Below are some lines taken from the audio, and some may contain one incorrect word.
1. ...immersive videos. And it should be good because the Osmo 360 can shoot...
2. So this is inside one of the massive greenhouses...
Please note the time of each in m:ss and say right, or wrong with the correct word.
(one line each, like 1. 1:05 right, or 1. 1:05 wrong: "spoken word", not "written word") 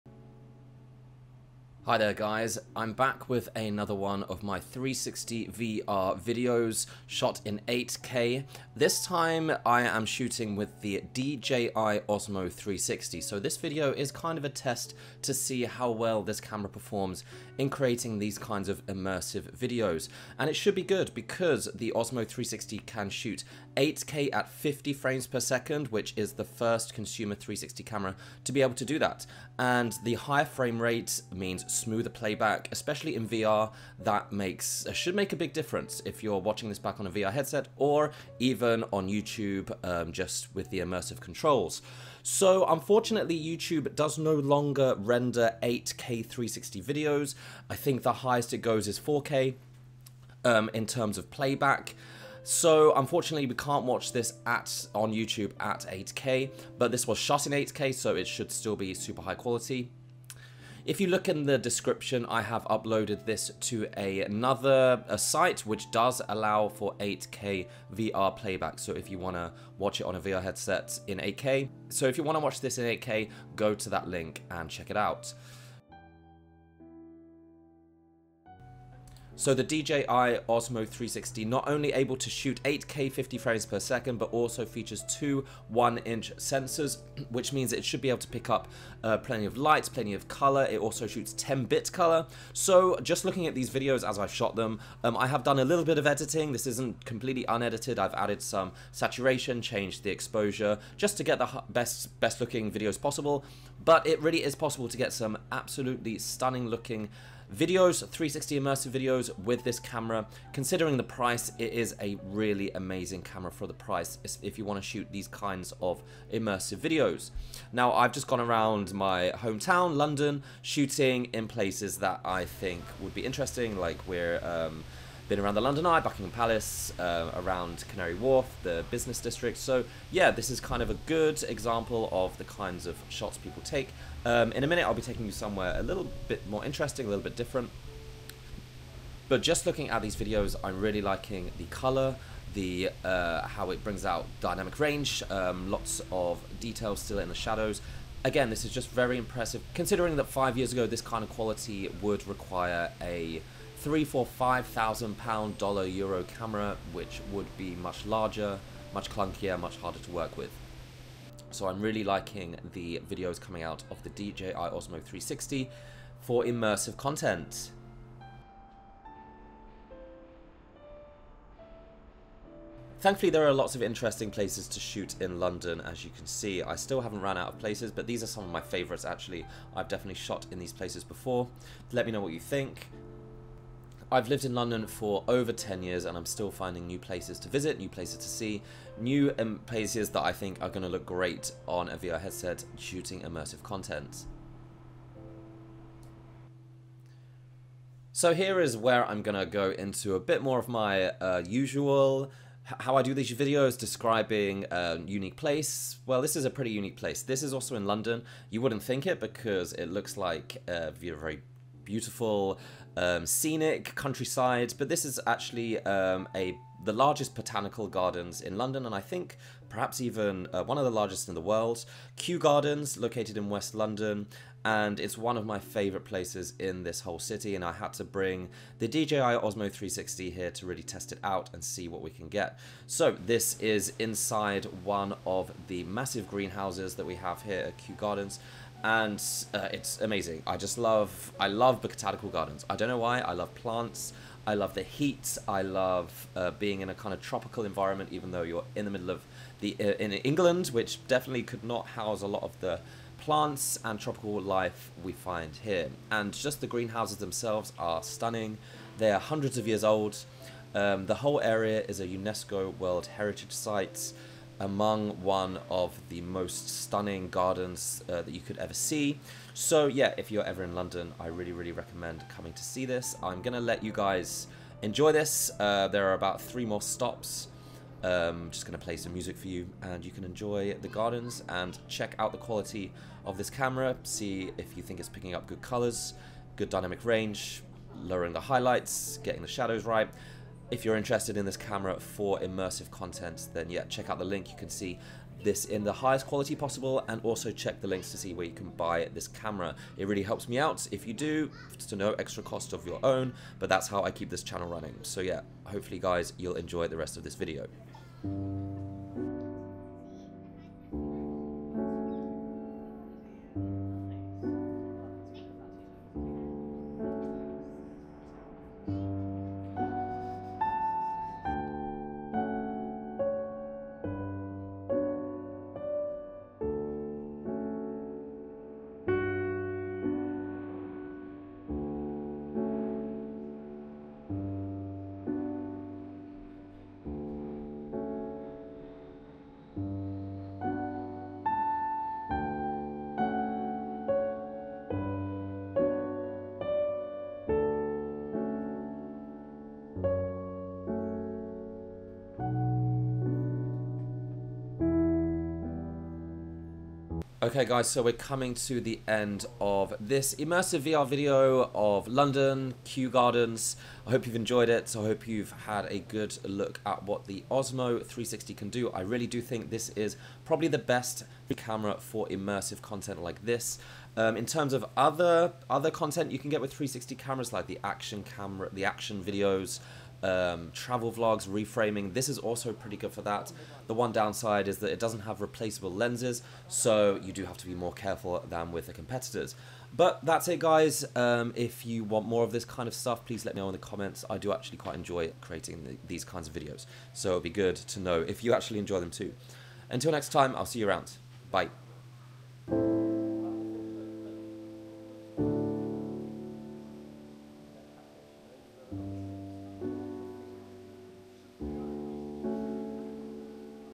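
1. 0:18 right
2. 3:52 right.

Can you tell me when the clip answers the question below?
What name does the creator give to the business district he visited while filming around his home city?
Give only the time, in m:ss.
2:07.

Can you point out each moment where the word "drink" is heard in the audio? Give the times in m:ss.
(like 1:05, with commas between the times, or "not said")
not said.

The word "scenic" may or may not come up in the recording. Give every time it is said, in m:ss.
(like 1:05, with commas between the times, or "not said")
3:33.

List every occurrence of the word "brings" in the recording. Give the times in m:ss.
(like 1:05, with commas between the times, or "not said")
2:23, 3:48.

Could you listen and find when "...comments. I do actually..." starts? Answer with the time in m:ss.
6:33.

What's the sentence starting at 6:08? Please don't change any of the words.
I really do think this is probably the best camera for immersive content like this.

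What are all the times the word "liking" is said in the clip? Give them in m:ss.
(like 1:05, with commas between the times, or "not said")
2:21, 2:42.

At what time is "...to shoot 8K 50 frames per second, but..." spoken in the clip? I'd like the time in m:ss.
1:22.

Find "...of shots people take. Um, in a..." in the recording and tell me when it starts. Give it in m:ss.
2:12.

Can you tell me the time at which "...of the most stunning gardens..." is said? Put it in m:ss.
4:25.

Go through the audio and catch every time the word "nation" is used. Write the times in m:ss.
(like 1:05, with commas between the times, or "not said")
not said.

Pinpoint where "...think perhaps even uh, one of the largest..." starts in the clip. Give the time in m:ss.
3:39.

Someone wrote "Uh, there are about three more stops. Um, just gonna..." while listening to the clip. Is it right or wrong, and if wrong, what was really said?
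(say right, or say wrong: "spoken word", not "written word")
right.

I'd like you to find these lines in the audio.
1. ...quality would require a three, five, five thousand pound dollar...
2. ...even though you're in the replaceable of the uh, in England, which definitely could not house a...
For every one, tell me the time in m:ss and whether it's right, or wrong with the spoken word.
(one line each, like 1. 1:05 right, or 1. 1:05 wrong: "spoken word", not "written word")
1. 2:31 wrong: "four", not "five"
2. 4:08 wrong: "middle", not "replaceable".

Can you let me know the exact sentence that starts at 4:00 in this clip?
I just love I love botanical gardens.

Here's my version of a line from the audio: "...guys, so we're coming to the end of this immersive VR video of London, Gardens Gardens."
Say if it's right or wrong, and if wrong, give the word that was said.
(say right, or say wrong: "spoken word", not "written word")
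wrong: "Kew", not "Gardens".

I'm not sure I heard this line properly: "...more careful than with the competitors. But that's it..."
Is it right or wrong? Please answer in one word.
right.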